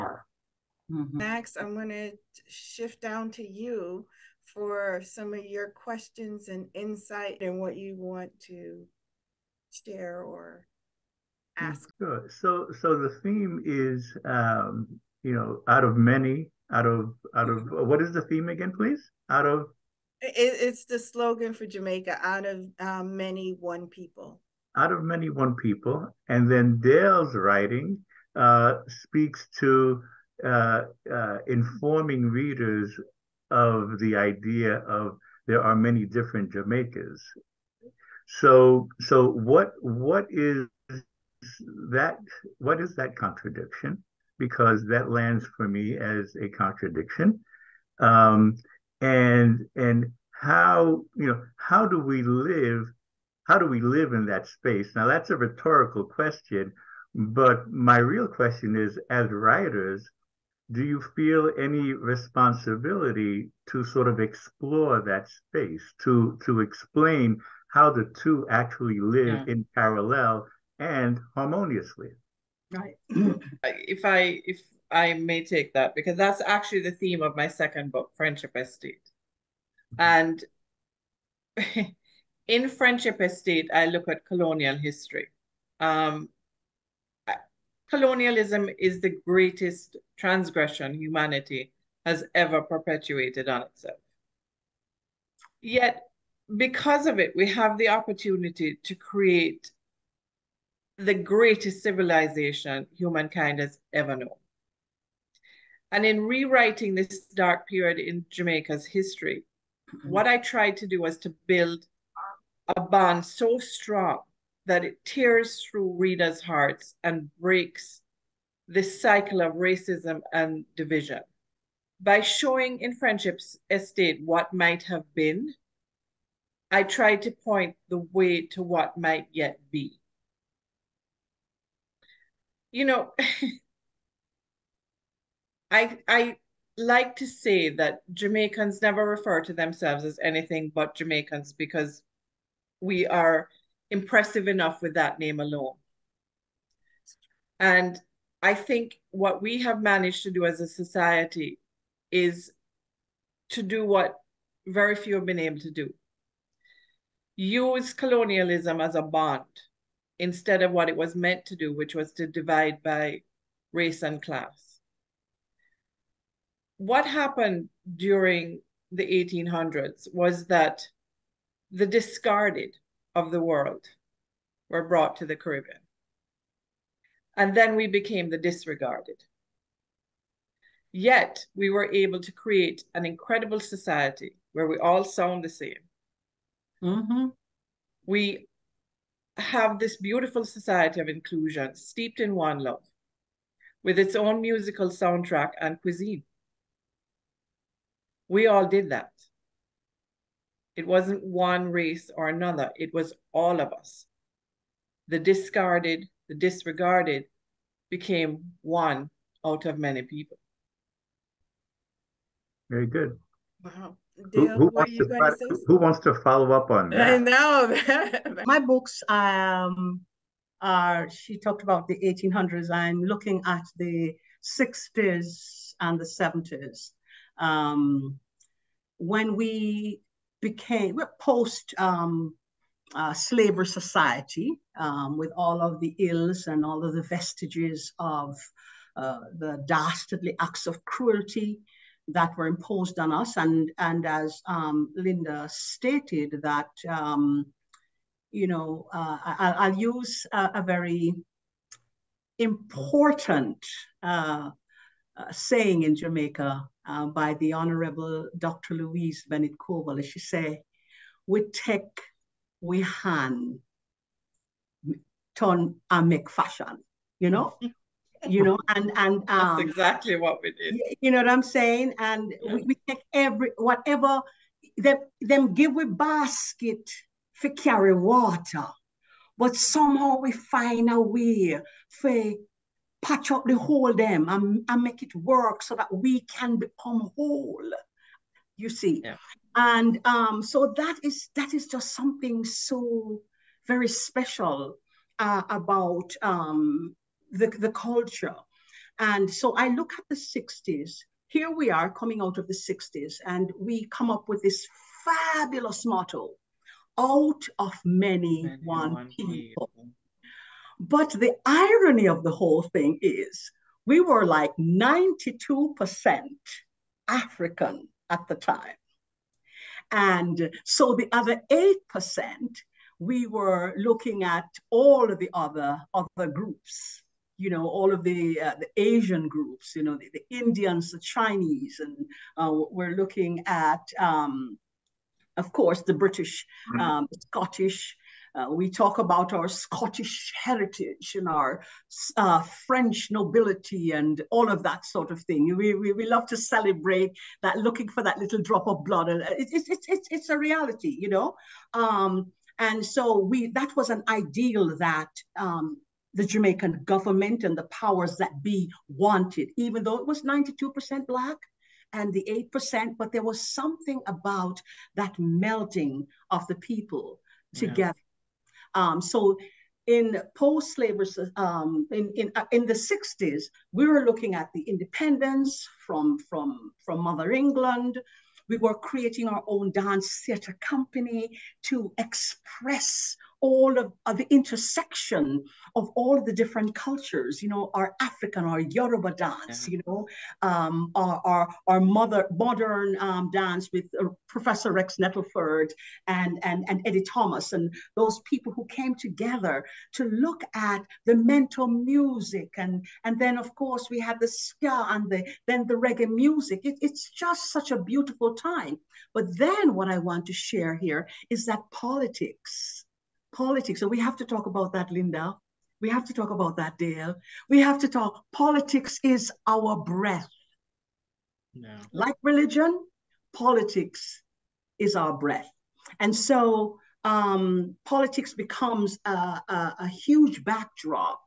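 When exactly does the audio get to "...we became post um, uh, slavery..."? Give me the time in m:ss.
3:49.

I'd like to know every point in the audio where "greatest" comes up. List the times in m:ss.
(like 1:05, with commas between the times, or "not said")
1:29, 1:41.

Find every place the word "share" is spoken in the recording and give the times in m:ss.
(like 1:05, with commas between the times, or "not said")
0:09, 6:50.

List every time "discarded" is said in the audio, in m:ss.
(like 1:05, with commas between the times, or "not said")
2:51, 3:25.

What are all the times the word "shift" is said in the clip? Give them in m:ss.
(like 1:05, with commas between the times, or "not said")
0:02.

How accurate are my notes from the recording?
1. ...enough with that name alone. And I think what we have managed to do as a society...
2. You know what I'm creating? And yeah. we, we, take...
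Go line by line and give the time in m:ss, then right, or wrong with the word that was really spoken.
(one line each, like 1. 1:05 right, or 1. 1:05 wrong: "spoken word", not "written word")
1. 2:24 right
2. 4:31 wrong: "saying", not "creating".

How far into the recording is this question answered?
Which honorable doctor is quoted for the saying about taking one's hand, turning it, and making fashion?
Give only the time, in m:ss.
4:18.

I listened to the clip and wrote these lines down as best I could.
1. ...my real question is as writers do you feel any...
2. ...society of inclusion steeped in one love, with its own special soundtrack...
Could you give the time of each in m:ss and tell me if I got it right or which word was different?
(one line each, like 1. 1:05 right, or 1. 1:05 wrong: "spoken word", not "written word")
1. 0:57 right
2. 3:10 wrong: "musical", not "special".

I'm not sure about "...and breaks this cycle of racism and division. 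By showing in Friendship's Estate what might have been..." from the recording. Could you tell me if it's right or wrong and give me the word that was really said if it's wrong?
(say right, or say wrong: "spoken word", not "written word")
right.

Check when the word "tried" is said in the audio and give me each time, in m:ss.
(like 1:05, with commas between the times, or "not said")
1:50, 2:06.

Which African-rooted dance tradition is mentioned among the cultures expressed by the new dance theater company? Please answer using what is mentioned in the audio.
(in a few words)
Yoruba dance.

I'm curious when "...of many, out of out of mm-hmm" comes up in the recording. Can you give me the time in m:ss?
0:15.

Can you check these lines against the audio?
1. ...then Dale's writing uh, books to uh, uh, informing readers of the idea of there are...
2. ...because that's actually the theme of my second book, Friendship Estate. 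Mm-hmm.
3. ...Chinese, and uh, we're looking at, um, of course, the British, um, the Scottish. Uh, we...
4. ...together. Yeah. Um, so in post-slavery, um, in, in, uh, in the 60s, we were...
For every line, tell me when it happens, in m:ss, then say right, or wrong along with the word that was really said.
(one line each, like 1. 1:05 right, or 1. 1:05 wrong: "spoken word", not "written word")
1. 0:26 wrong: "speaks", not "books"
2. 1:15 right
3. 5:30 right
4. 6:07 right.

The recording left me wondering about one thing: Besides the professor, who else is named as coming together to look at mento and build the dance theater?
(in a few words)
Eddie Thomas.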